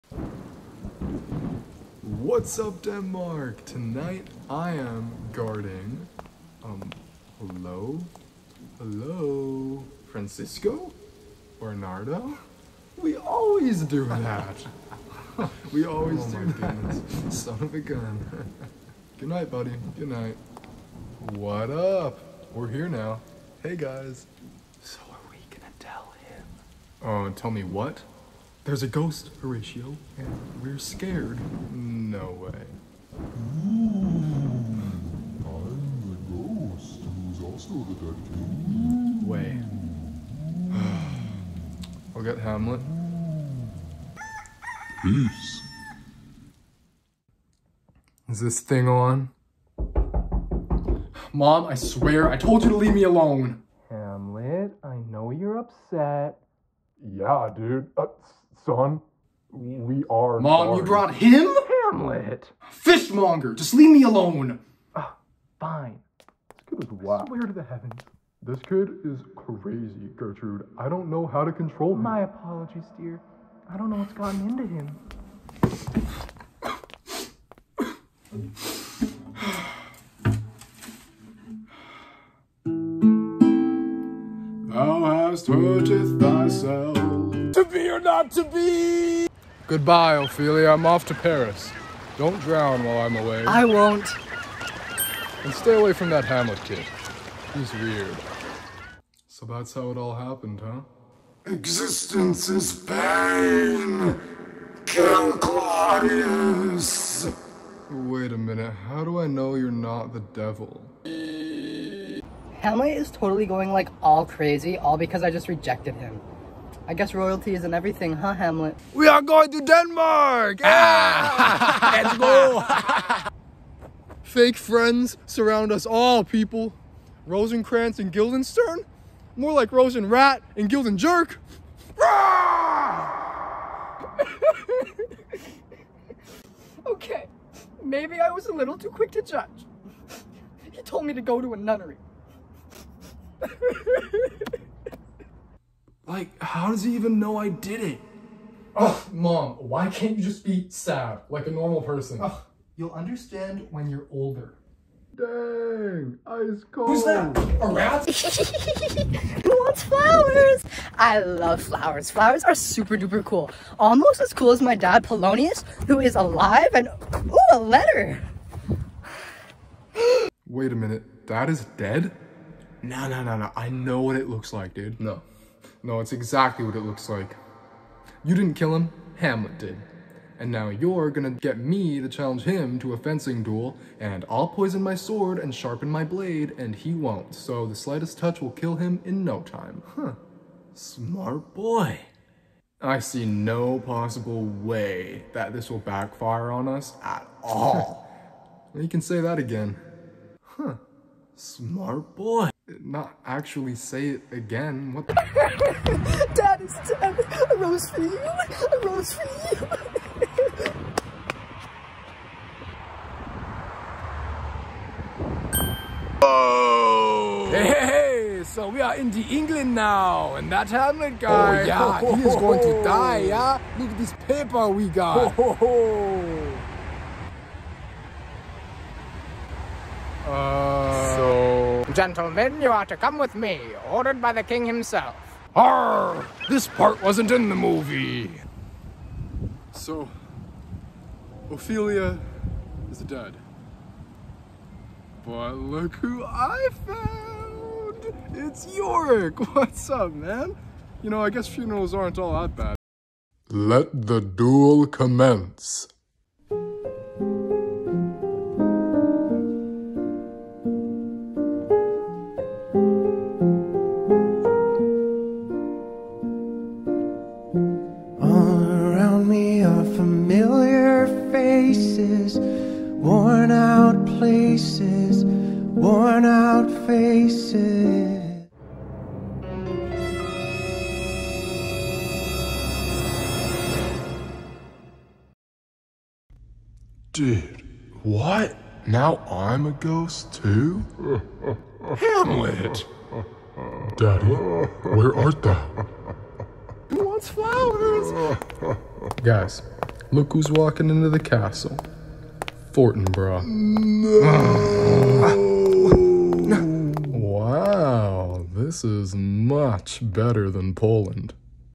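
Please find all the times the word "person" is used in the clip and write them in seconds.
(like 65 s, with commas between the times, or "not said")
151 s.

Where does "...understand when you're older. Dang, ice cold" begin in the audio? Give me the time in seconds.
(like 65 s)
152 s.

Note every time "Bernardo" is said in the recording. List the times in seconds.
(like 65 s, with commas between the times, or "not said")
11 s.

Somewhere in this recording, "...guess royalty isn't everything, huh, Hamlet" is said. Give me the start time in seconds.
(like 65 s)
116 s.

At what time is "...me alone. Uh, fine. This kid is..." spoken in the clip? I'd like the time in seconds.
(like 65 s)
63 s.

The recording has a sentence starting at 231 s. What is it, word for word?
Gentlemen, you are to come with me, ordered by the king himself.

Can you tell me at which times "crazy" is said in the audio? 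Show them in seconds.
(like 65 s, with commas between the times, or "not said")
69 s, 114 s.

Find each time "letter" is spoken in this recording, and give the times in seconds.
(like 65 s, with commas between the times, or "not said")
167 s.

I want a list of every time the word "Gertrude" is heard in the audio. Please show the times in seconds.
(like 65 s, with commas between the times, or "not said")
70 s.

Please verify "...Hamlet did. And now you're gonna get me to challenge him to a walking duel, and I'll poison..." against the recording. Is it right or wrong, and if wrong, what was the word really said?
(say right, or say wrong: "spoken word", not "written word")
wrong: "fencing", not "walking".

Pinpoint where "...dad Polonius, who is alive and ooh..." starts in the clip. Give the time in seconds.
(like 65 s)
164 s.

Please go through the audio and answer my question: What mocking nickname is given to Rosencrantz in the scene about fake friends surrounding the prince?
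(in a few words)
Rosen Rat.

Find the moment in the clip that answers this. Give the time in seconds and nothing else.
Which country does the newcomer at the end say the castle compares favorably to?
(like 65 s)
310 s.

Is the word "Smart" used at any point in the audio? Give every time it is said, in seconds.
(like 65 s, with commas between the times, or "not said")
190 s, 201 s.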